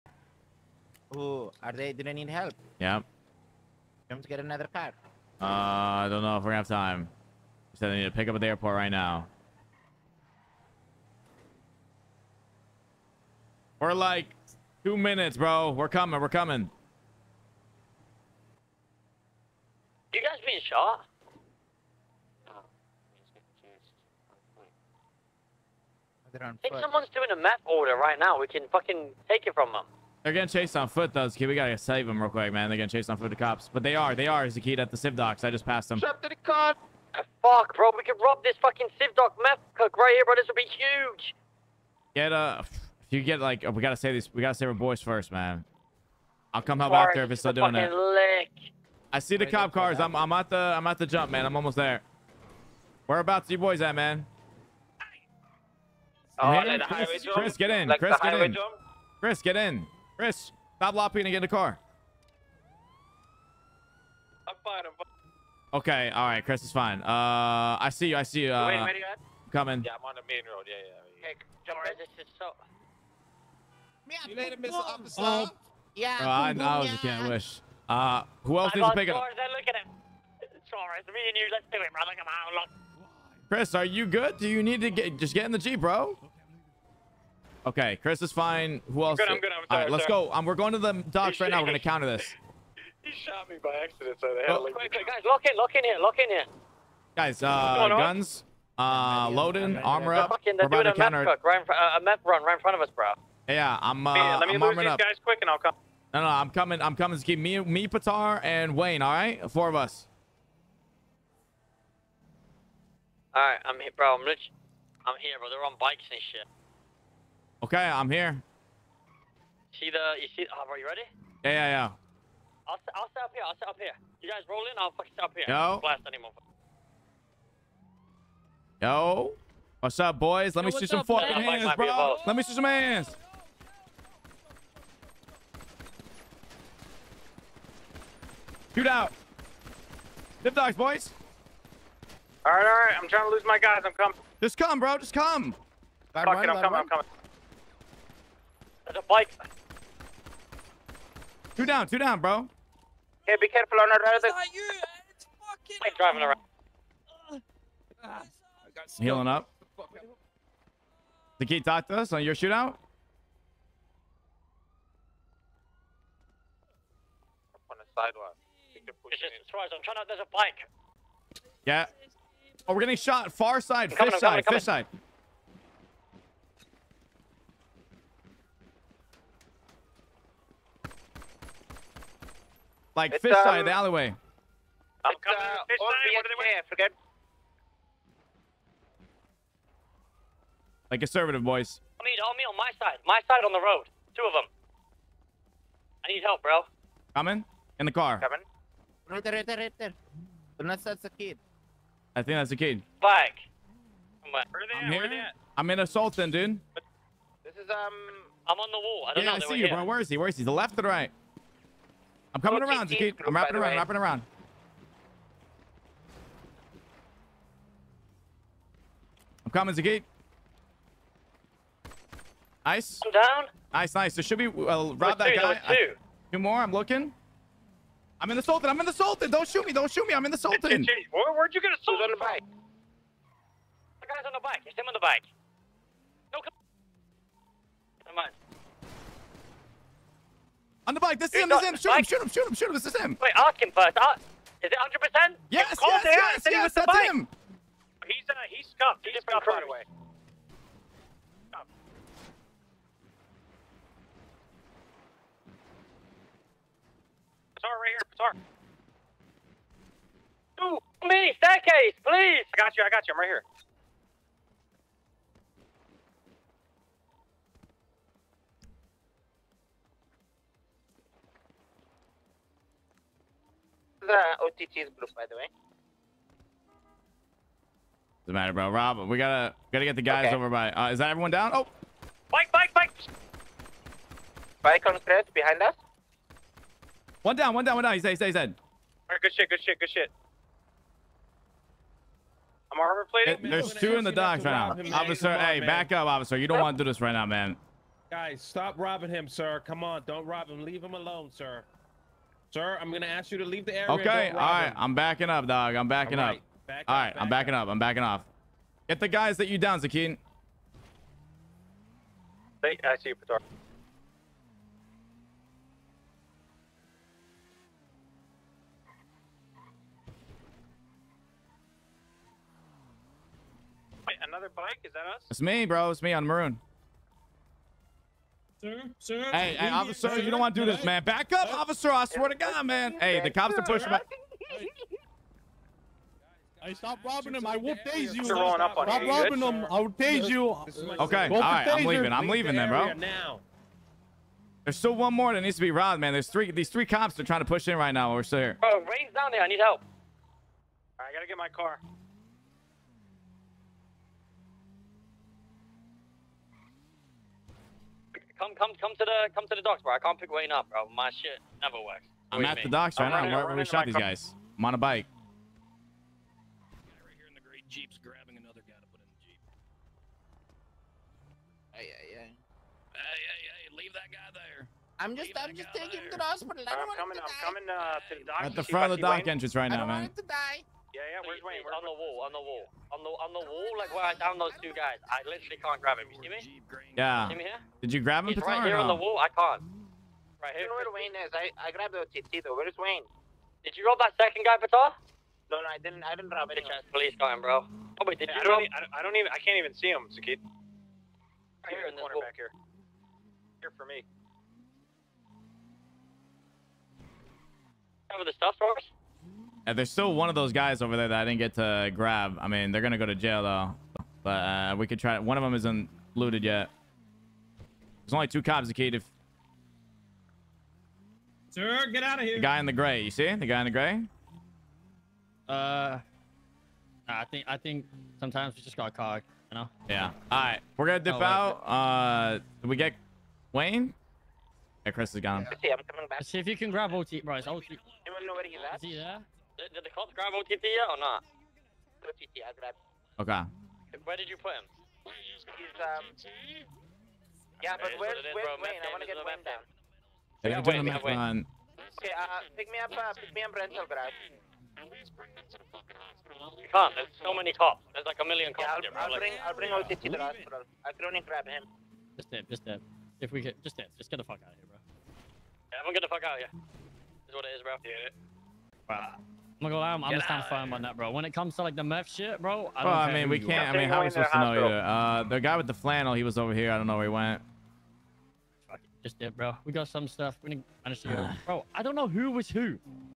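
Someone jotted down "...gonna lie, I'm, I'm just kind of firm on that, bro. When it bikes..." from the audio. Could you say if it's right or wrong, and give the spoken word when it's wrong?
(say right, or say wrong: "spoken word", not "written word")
wrong: "comes", not "bikes".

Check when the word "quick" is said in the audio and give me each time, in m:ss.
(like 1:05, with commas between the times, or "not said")
0:32, 1:45.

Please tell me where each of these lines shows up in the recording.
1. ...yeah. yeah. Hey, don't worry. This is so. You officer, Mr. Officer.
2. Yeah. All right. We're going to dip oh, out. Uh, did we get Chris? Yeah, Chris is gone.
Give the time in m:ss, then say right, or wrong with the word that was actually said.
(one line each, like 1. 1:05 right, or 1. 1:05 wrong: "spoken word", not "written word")
1. 1:10 wrong: "later", not "officer"
2. 7:09 wrong: "Wayne", not "Chris".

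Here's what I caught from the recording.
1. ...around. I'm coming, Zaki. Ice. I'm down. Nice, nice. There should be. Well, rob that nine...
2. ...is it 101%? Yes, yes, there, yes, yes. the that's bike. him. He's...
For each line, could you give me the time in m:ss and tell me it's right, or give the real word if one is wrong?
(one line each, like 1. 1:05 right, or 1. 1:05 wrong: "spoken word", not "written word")
1. 3:33 wrong: "two", not "nine"
2. 4:04 wrong: "100", not "101".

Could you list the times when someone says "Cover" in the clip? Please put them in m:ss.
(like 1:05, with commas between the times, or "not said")
6:48.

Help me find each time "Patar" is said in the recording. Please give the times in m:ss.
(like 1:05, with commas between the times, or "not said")
1:47, 5:13, 6:34.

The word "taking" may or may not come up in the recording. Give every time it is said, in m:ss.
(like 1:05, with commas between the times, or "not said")
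6:15.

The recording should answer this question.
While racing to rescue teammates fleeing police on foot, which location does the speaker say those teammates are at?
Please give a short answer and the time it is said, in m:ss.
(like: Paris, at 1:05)
Civ docks, at 0:34.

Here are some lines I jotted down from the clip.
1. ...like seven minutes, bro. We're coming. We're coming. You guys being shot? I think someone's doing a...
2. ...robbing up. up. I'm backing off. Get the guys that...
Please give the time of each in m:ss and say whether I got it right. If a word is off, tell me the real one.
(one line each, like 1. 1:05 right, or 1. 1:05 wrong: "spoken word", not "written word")
1. 0:13 wrong: "two", not "seven"
2. 5:07 wrong: "backing", not "robbing".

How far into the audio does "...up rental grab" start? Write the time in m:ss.
7:33.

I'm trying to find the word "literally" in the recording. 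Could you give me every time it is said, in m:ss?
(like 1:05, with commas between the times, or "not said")
6:25.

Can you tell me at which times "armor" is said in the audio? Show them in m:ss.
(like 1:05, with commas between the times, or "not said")
1:39, 4:52.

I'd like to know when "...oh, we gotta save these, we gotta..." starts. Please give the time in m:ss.
0:43.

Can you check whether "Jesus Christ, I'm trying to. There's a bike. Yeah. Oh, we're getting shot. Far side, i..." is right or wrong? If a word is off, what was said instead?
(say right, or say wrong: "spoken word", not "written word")
right.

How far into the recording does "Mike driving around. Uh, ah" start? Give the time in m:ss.
2:35.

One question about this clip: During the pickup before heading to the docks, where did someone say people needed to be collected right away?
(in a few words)
The airport.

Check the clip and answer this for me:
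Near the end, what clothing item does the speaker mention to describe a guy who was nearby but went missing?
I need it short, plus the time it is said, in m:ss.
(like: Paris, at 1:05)
Flannel, at 7:55.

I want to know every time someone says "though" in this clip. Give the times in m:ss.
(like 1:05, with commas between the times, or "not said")
0:31, 6:32, 6:53.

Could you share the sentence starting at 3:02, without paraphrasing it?
Like it's, fish um, side, the alleyway.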